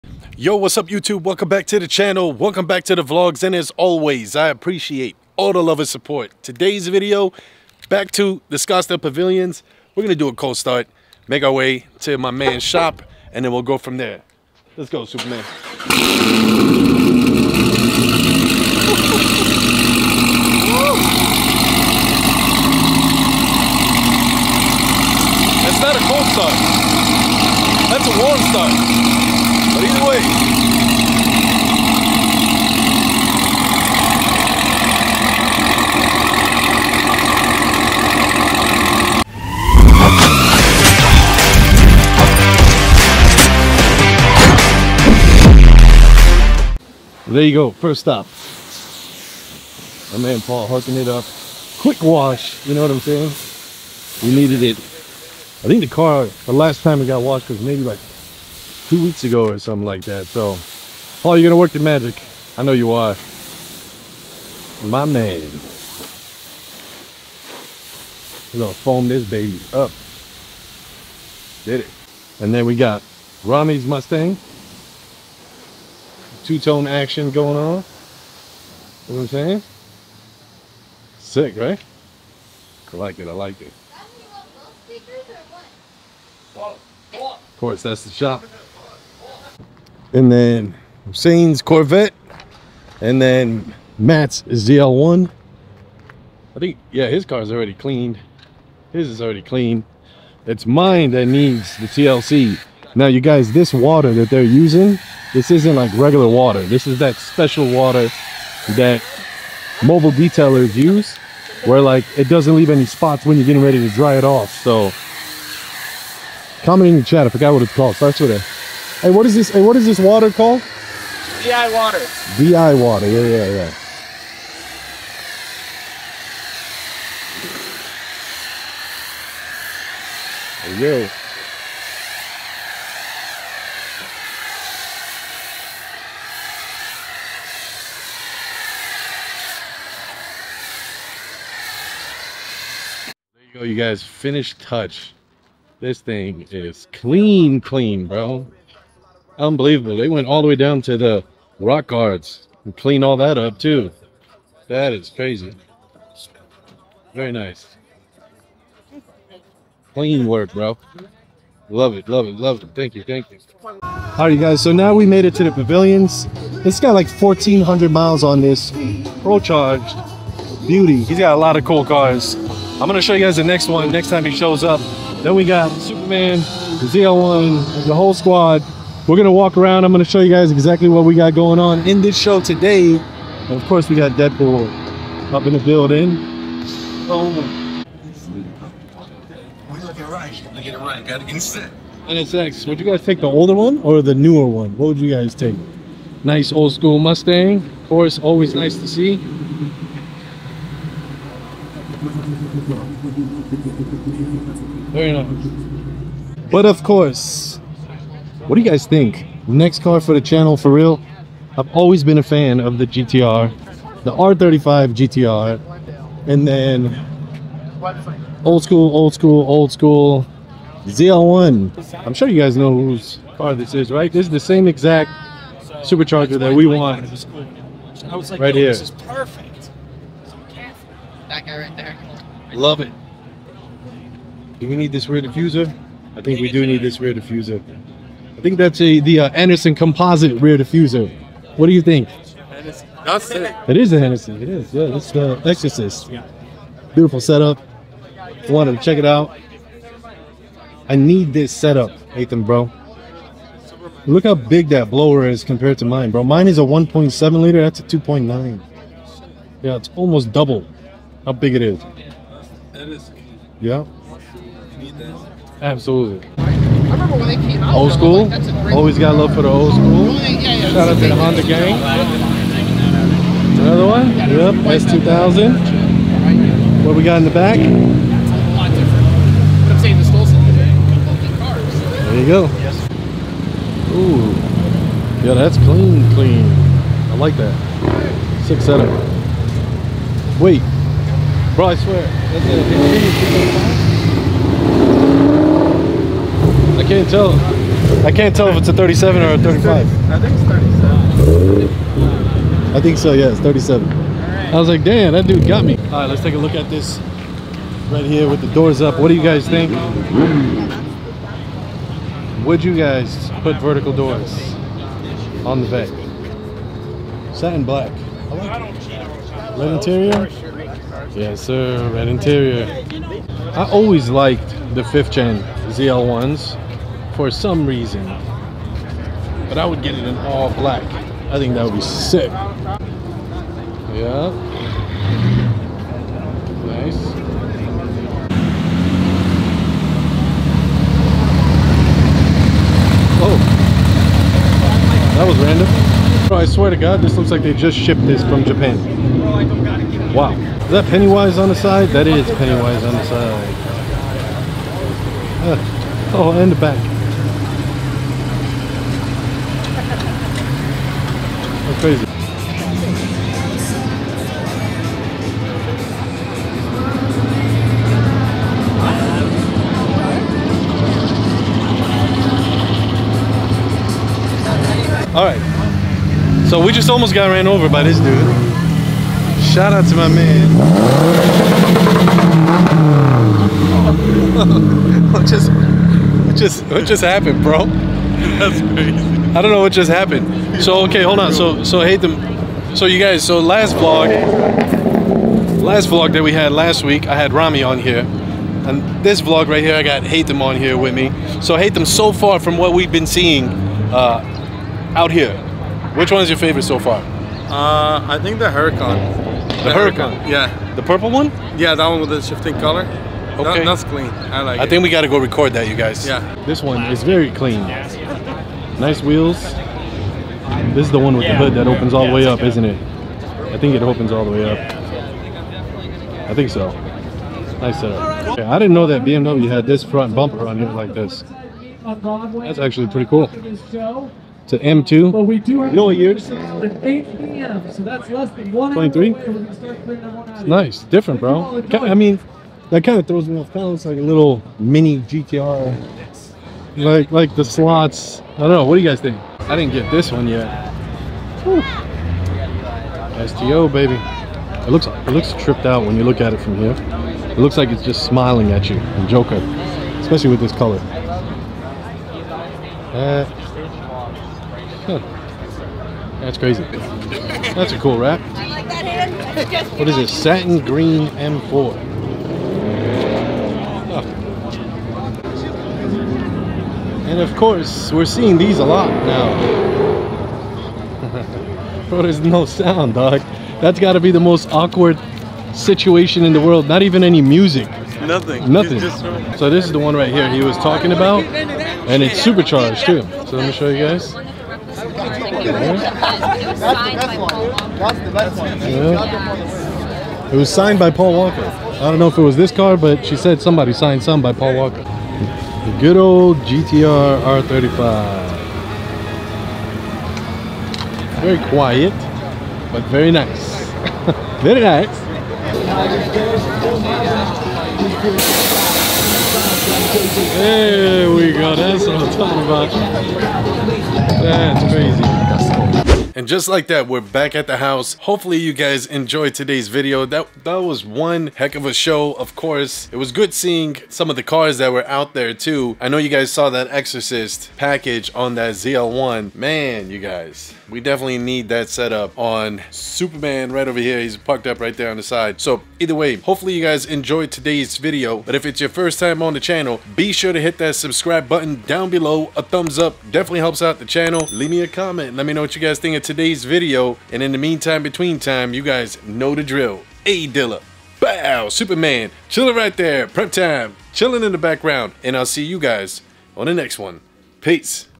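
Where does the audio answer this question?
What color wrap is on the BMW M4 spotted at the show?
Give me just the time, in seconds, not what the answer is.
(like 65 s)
470 s.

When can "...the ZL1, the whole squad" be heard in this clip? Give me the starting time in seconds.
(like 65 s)
176 s.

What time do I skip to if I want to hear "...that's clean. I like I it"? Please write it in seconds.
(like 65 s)
413 s.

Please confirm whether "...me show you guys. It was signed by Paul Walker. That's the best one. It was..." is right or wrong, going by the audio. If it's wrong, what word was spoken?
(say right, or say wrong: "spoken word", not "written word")
right.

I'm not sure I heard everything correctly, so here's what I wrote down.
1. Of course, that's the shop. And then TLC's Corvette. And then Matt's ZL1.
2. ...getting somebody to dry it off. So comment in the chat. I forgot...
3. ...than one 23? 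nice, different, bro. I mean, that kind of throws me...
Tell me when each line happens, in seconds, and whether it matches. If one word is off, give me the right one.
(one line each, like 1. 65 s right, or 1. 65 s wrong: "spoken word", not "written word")
1. 86 s wrong: "Hussein", not "TLC"
2. 113 s wrong: "ready", not "somebody"
3. 438 s right.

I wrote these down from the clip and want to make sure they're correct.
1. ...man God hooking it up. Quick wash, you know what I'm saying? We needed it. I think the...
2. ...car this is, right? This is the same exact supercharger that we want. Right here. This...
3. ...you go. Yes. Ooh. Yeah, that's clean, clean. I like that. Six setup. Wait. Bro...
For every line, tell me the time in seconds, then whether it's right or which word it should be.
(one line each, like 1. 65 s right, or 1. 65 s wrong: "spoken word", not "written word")
1. 50 s wrong: "Paul", not "God"
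2. 223 s right
3. 282 s right.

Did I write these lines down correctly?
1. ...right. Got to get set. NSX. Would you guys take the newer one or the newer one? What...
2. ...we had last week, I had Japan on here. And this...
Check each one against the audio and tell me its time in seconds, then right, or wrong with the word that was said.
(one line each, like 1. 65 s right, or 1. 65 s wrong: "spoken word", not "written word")
1. 190 s wrong: "older", not "newer"
2. 396 s wrong: "Rami", not "Japan".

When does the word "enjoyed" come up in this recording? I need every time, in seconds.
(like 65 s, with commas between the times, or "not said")
528 s, 546 s.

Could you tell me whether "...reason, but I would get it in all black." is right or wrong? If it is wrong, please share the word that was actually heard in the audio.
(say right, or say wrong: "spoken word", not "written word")
right.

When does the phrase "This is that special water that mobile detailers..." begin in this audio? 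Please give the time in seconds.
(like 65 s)
106 s.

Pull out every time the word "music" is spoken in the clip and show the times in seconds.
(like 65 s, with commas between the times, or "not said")
487 s.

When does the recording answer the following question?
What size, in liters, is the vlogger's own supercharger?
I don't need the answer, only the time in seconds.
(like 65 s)
256 s.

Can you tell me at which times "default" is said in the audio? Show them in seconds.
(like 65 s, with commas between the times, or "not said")
not said.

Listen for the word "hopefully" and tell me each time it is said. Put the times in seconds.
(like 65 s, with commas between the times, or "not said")
528 s, 546 s.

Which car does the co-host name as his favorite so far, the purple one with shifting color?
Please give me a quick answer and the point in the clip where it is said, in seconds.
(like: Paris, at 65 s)
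Huracan, at 408 s.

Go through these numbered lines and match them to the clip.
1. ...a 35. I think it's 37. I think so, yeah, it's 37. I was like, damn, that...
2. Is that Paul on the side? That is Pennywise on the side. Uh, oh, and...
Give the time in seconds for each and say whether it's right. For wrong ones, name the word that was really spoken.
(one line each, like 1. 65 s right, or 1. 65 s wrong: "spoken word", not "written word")
1. 299 s right
2. 350 s wrong: "Pennywise", not "Paul".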